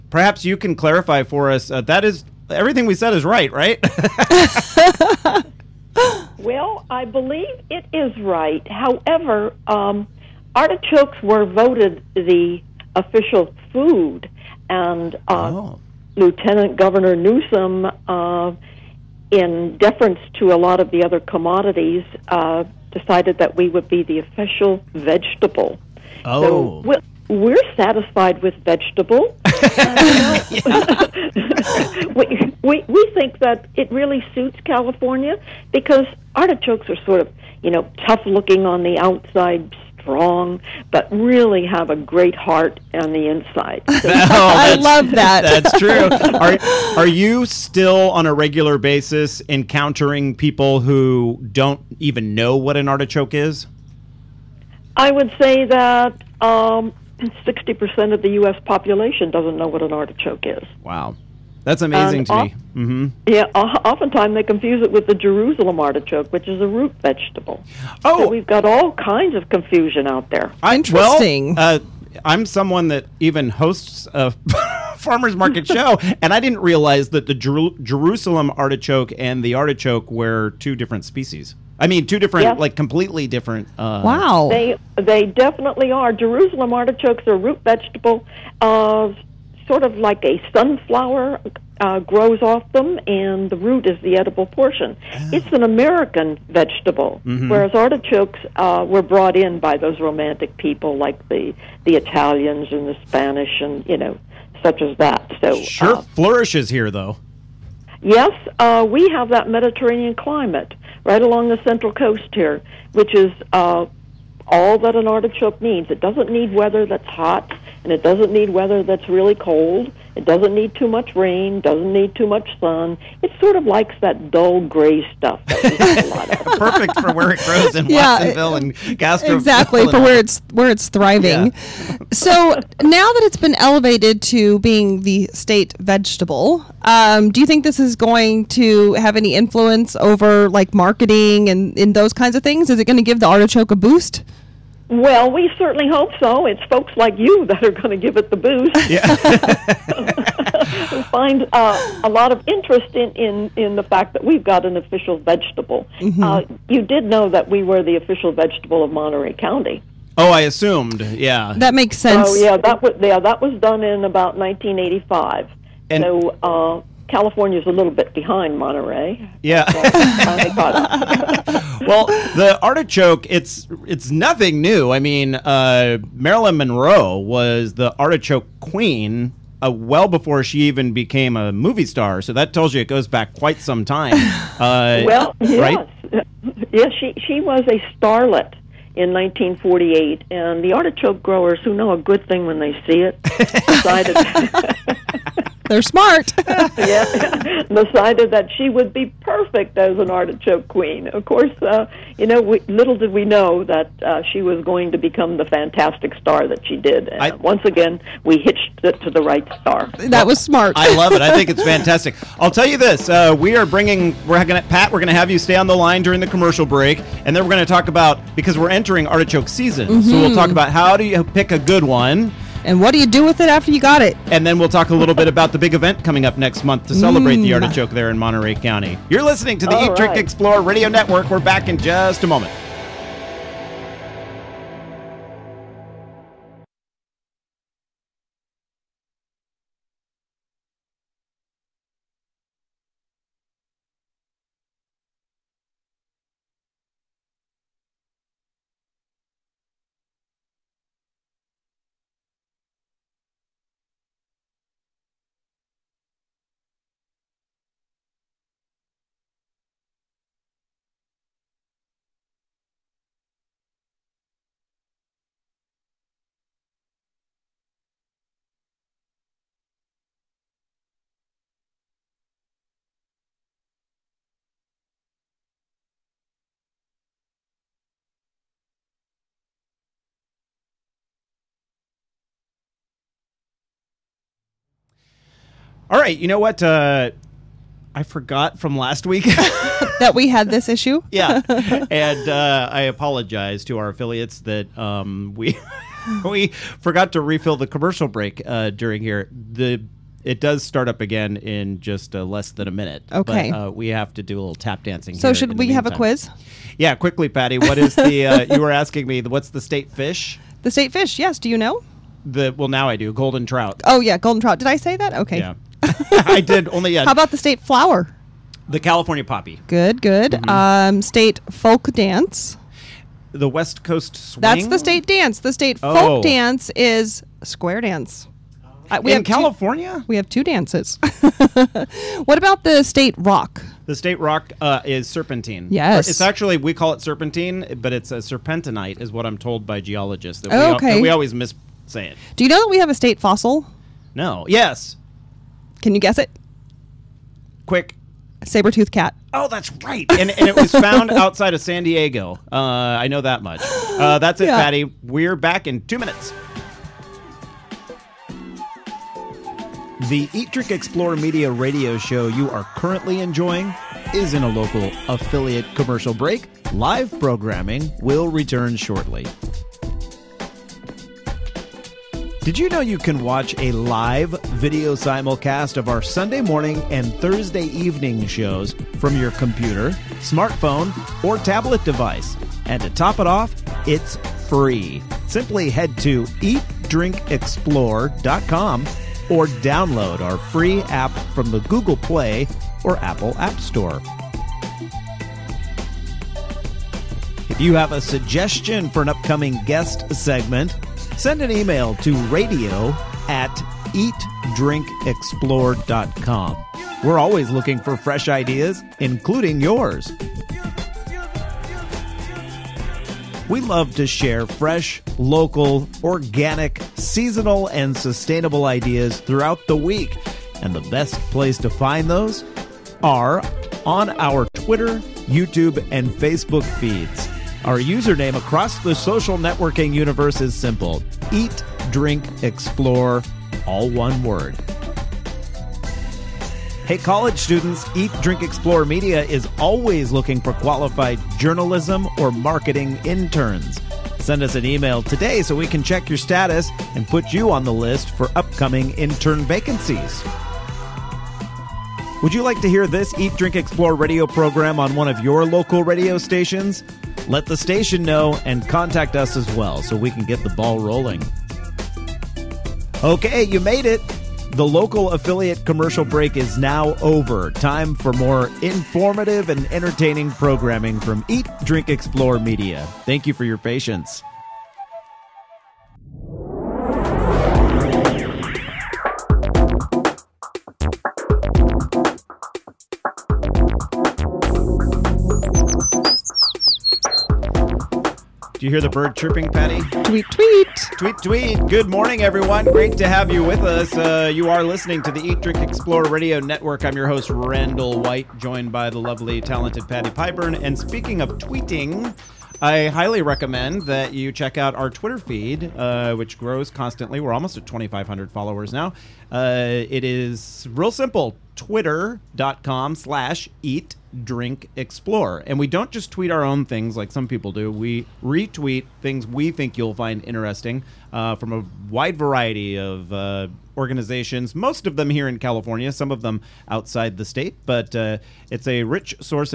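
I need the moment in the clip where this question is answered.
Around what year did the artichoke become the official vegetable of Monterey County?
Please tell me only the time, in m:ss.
2:44.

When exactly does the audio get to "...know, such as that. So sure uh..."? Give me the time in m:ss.
1:43.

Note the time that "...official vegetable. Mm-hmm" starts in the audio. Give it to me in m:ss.
2:34.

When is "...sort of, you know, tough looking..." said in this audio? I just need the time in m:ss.
0:37.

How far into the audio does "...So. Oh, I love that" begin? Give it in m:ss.
0:44.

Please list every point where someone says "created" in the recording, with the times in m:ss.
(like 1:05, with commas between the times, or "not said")
not said.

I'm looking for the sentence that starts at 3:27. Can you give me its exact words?
And I, once again, we hitched it to the right star.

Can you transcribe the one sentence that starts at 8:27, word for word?
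We're almost at 2,500 followers now.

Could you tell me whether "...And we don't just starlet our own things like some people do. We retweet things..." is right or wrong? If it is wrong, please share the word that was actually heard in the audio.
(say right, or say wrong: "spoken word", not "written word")
wrong: "tweet", not "starlet".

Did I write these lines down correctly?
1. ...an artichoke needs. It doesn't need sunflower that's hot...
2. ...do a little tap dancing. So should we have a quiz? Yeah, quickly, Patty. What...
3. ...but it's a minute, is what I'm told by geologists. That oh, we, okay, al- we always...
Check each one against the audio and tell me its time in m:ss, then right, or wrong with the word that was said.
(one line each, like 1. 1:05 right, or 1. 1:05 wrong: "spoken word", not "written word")
1. 1:54 wrong: "weather", not "sunflower"
2. 5:04 right
3. 5:37 wrong: "serpentinite", not "minute".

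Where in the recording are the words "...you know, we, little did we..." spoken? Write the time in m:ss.
3:22.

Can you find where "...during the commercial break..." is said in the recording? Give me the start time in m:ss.
3:36.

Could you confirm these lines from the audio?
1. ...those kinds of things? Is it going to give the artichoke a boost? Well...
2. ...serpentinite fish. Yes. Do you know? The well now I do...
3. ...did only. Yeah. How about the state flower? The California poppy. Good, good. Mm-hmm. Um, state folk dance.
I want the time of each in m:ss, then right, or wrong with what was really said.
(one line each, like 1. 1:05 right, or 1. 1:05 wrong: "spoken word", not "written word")
1. 2:21 right
2. 5:10 wrong: "state", not "serpentinite"
3. 5:16 right.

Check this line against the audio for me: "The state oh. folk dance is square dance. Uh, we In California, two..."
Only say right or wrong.
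right.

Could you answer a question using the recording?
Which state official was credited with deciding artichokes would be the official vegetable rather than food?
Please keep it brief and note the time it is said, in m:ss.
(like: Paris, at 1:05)
Lieutenant Governor Newsom, at 0:16.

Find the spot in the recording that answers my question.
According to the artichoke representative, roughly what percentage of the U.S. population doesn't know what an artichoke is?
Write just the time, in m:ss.
0:57.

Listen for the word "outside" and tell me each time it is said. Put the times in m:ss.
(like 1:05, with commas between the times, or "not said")
0:38, 5:51, 8:46.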